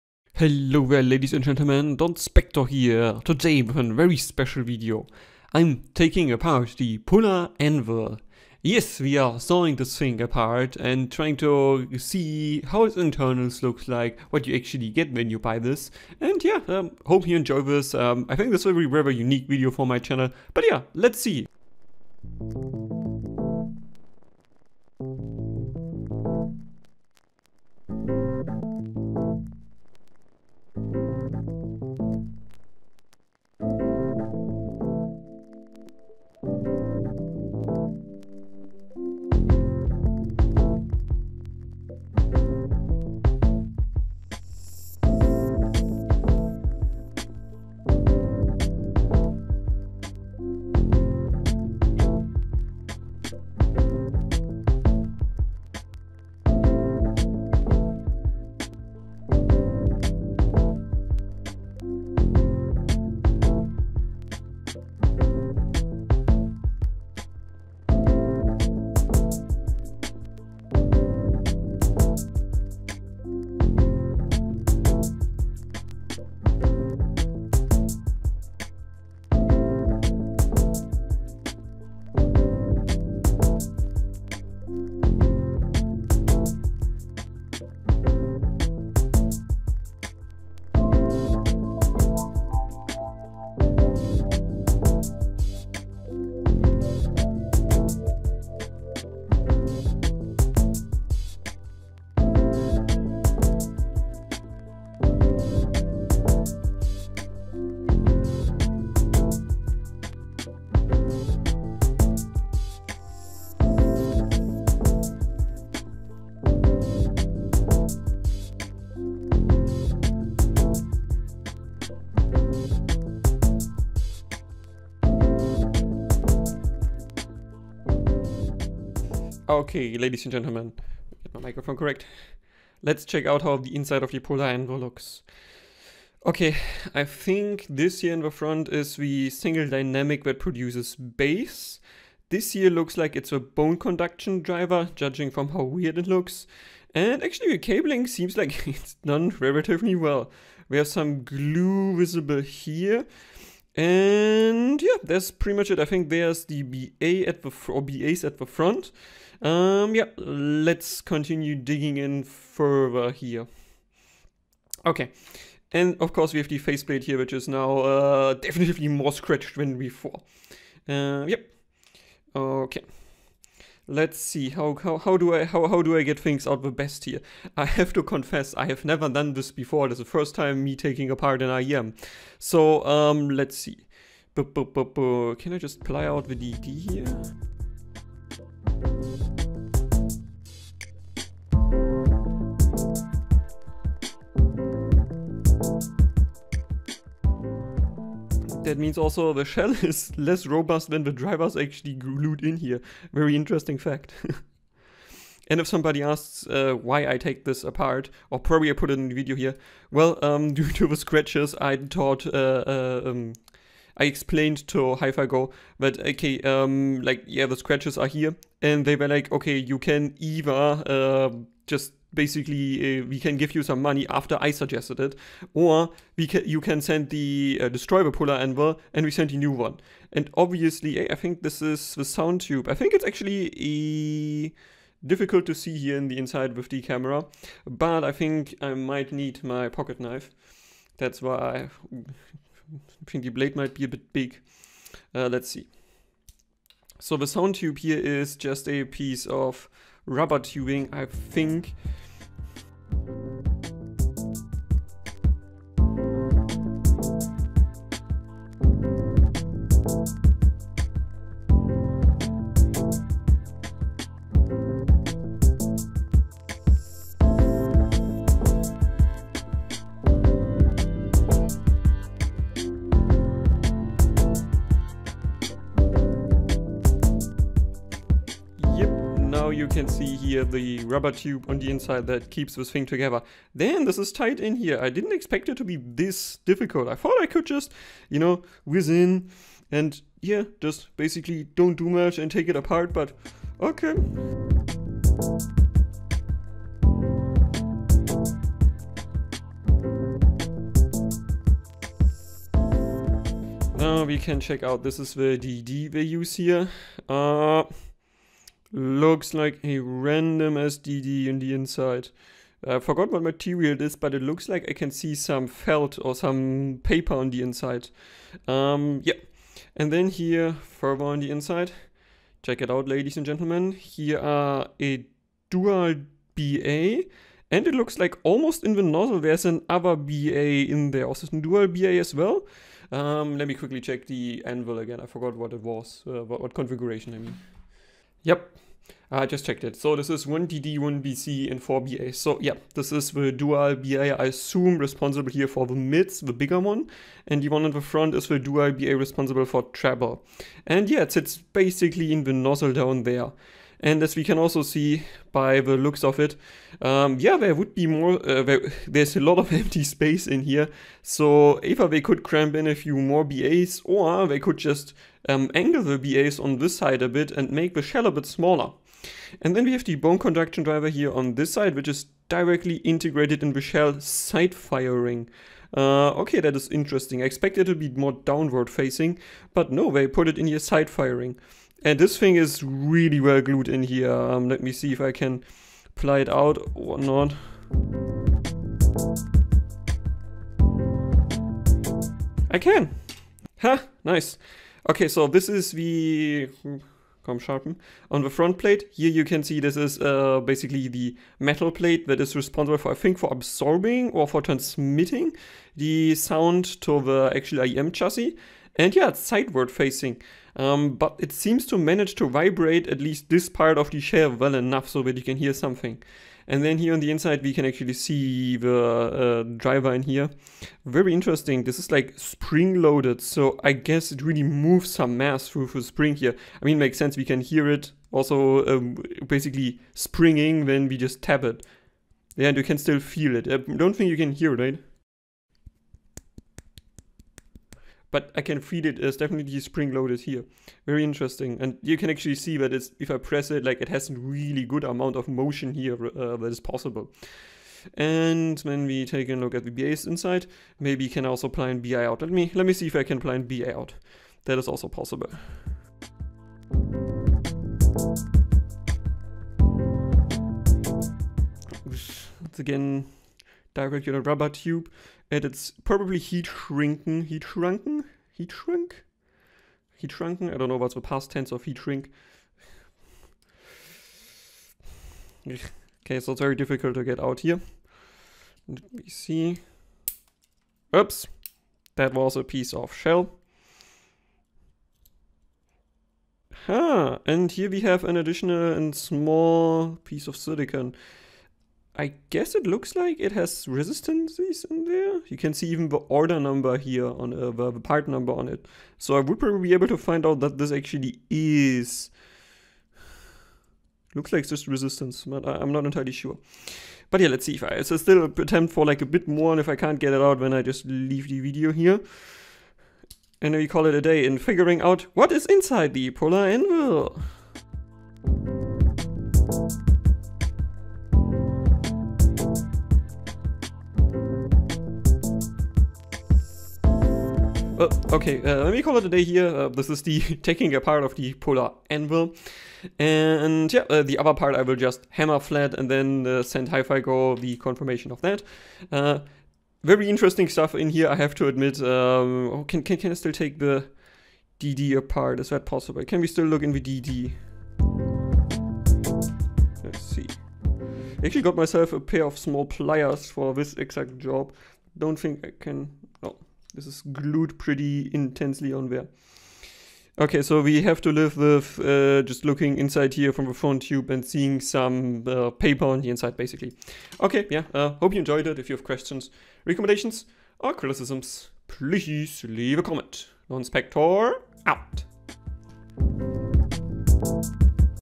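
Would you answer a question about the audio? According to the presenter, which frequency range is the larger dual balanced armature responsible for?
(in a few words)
mids.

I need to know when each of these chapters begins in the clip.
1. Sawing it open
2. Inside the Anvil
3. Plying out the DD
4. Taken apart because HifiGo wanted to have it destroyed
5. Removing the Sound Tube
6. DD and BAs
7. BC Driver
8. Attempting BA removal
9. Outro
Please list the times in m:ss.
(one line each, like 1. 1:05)
1. 0:21
2. 2:08
3. 3:04
4. 3:26
5. 3:52
6. 5:03
7. 6:08
8. 7:29
9. 8:48.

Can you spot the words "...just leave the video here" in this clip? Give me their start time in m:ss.
8:30.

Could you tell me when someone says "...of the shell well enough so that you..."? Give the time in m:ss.
6:53.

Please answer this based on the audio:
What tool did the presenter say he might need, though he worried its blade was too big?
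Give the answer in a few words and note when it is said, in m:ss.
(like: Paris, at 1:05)
pocket knife, at 3:59.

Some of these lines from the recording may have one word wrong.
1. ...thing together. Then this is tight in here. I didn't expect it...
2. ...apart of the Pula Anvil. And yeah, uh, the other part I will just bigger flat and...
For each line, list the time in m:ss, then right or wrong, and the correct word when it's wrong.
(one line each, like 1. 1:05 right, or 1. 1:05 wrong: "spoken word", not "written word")
1. 4:42 right
2. 8:50 wrong: "hammer", not "bigger".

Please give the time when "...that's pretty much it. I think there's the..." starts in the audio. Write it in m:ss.
2:35.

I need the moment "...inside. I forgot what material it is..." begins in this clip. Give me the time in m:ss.
5:11.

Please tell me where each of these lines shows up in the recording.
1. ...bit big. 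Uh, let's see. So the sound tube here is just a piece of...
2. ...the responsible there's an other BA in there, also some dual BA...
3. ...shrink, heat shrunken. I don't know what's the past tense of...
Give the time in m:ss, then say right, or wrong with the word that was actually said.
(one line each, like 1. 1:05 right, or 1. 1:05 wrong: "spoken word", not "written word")
1. 4:03 right
2. 5:28 wrong: "nozzle", not "responsible"
3. 7:48 right.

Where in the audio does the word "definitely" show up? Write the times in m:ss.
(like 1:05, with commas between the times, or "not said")
2:48, 7:19.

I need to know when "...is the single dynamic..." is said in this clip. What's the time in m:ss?
2:18.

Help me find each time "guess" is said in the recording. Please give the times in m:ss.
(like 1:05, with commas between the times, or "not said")
7:03, 8:12.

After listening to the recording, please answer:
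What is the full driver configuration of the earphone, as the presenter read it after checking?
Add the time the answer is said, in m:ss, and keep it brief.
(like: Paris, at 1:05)
1DD, 1BC, 4BA, at 5:40.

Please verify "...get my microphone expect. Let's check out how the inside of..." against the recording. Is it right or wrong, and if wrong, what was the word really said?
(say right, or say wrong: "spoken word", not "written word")
wrong: "correct", not "expect".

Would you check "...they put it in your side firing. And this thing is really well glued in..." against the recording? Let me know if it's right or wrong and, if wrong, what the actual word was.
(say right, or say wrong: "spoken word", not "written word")
right.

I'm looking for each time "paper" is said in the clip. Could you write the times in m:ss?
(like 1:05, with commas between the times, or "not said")
5:16, 9:25.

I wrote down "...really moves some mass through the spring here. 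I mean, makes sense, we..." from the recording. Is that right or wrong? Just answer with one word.
right.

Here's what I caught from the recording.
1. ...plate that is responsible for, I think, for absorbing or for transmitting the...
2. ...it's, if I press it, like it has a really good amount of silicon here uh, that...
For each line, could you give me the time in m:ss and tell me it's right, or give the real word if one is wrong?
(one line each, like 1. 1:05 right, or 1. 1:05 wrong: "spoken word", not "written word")
1. 6:41 right
2. 7:22 wrong: "motion", not "silicon".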